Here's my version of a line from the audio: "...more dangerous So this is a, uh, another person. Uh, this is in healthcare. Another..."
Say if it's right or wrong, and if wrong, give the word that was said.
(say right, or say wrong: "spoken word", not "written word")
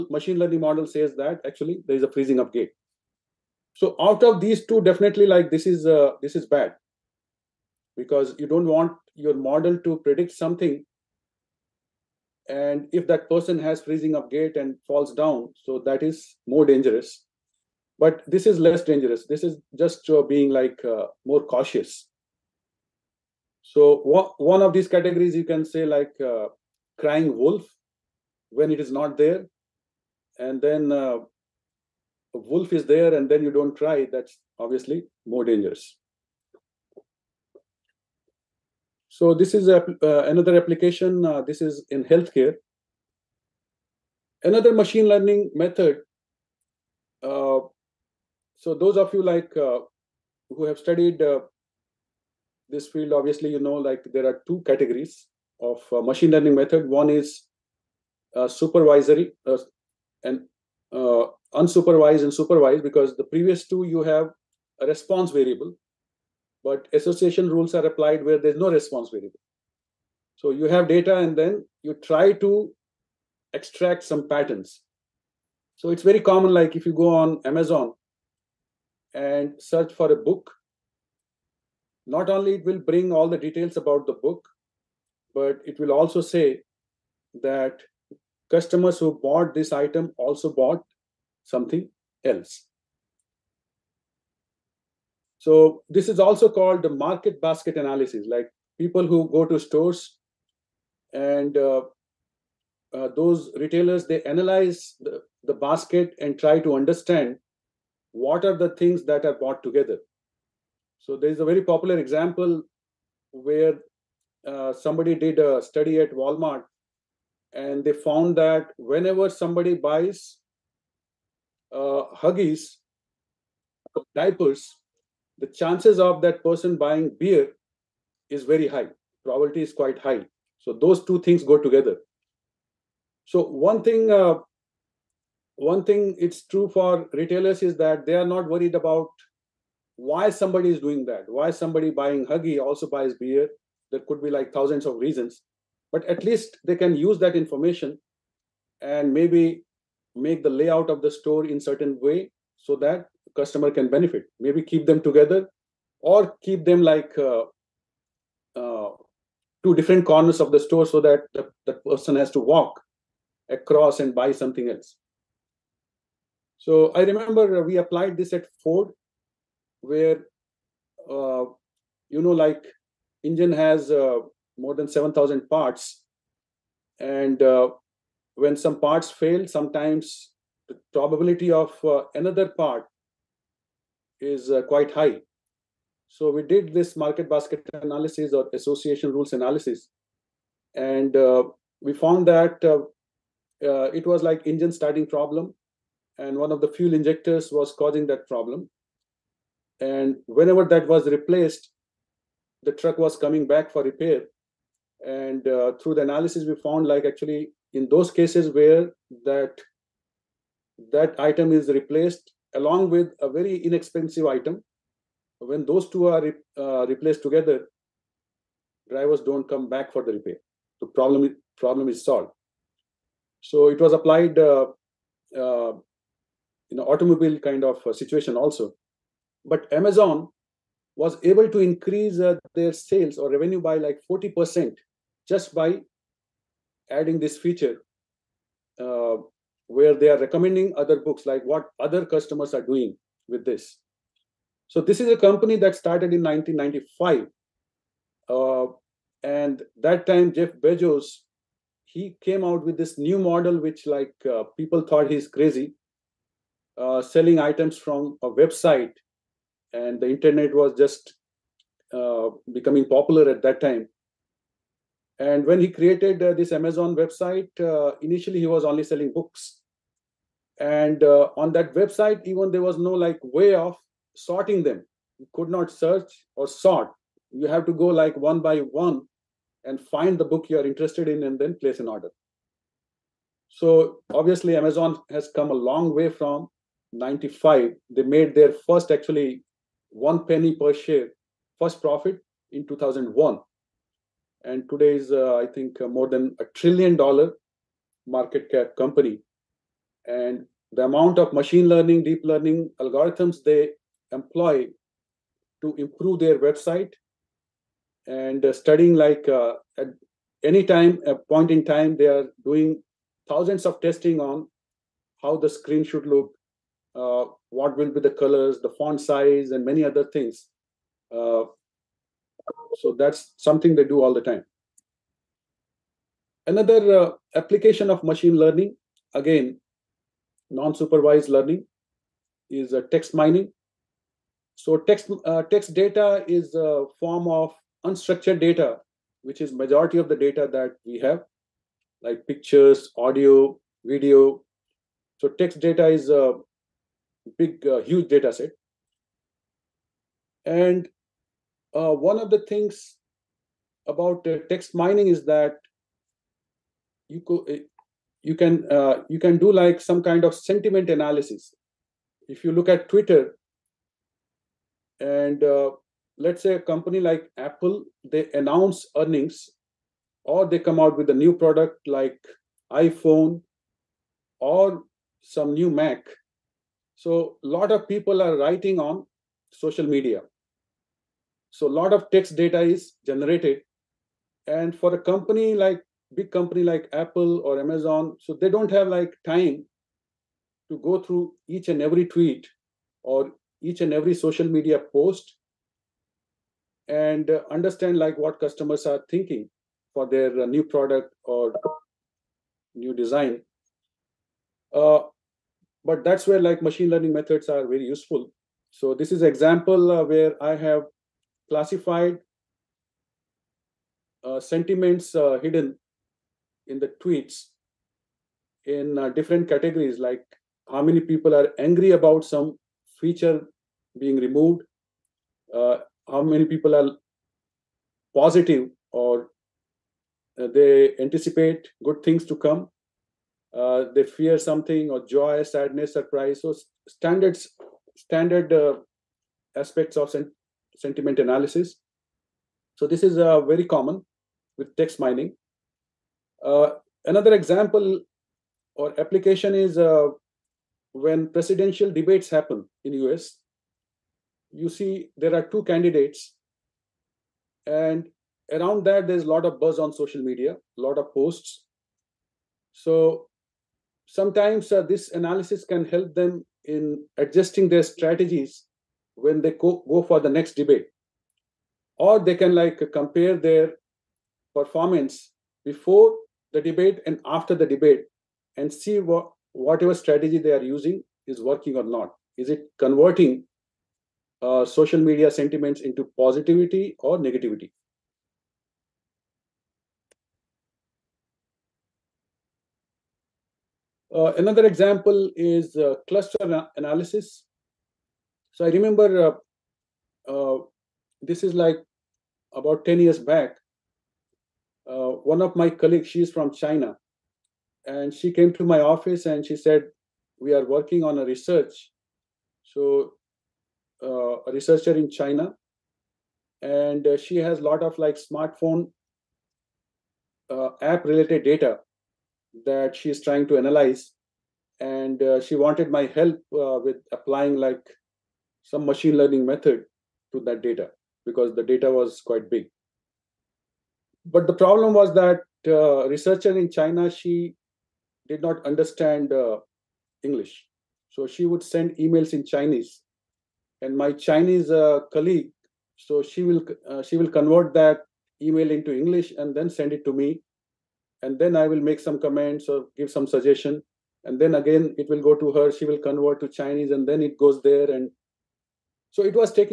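wrong: "application", not "person".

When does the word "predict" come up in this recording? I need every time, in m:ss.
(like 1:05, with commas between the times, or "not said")
0:09.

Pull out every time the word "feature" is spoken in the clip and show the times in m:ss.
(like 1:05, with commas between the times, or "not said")
3:57, 7:02.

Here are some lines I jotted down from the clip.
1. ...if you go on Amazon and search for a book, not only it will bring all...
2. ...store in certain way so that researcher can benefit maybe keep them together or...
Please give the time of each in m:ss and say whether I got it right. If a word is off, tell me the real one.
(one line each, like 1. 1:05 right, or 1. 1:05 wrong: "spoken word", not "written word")
1. 1:16 right
2. 2:31 wrong: "customer", not "researcher".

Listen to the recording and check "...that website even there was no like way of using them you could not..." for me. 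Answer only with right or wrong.
wrong.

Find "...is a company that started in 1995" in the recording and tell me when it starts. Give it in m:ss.
4:04.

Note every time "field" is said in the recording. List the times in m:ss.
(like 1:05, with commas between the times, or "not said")
0:52.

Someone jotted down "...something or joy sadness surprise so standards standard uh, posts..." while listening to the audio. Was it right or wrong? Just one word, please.
wrong.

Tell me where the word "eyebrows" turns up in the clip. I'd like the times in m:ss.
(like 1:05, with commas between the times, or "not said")
not said.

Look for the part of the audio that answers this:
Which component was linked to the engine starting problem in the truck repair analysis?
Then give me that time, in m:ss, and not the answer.
3:16.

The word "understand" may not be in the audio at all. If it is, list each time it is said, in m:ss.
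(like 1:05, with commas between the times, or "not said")
1:46, 6:37, 8:58.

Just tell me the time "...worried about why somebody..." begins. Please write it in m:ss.
2:18.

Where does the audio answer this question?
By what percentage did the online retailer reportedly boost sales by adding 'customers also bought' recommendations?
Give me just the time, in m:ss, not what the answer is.
3:54.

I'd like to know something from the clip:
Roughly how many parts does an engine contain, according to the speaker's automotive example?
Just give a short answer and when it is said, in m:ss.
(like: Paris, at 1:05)
7000, at 2:54.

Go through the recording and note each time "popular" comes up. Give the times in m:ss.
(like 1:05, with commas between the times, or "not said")
1:51, 4:22.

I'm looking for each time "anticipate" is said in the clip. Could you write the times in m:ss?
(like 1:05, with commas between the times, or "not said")
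7:10.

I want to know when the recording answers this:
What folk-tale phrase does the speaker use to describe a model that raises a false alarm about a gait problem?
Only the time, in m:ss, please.
0:26.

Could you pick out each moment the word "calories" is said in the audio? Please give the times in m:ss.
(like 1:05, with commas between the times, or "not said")
not said.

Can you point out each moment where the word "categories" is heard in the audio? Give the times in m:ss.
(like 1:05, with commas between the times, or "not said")
0:24, 0:54, 6:59.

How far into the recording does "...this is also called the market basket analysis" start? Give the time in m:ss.
1:35.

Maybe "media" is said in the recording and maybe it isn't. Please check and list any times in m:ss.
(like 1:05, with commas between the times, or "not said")
6:19, 6:34, 7:40, 8:04.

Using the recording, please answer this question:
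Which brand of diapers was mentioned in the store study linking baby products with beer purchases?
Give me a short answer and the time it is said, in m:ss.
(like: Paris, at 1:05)
Huggies, at 2:02.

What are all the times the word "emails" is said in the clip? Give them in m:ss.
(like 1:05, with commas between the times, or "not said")
9:01, 9:08.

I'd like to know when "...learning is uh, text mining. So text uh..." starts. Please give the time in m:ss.
5:31.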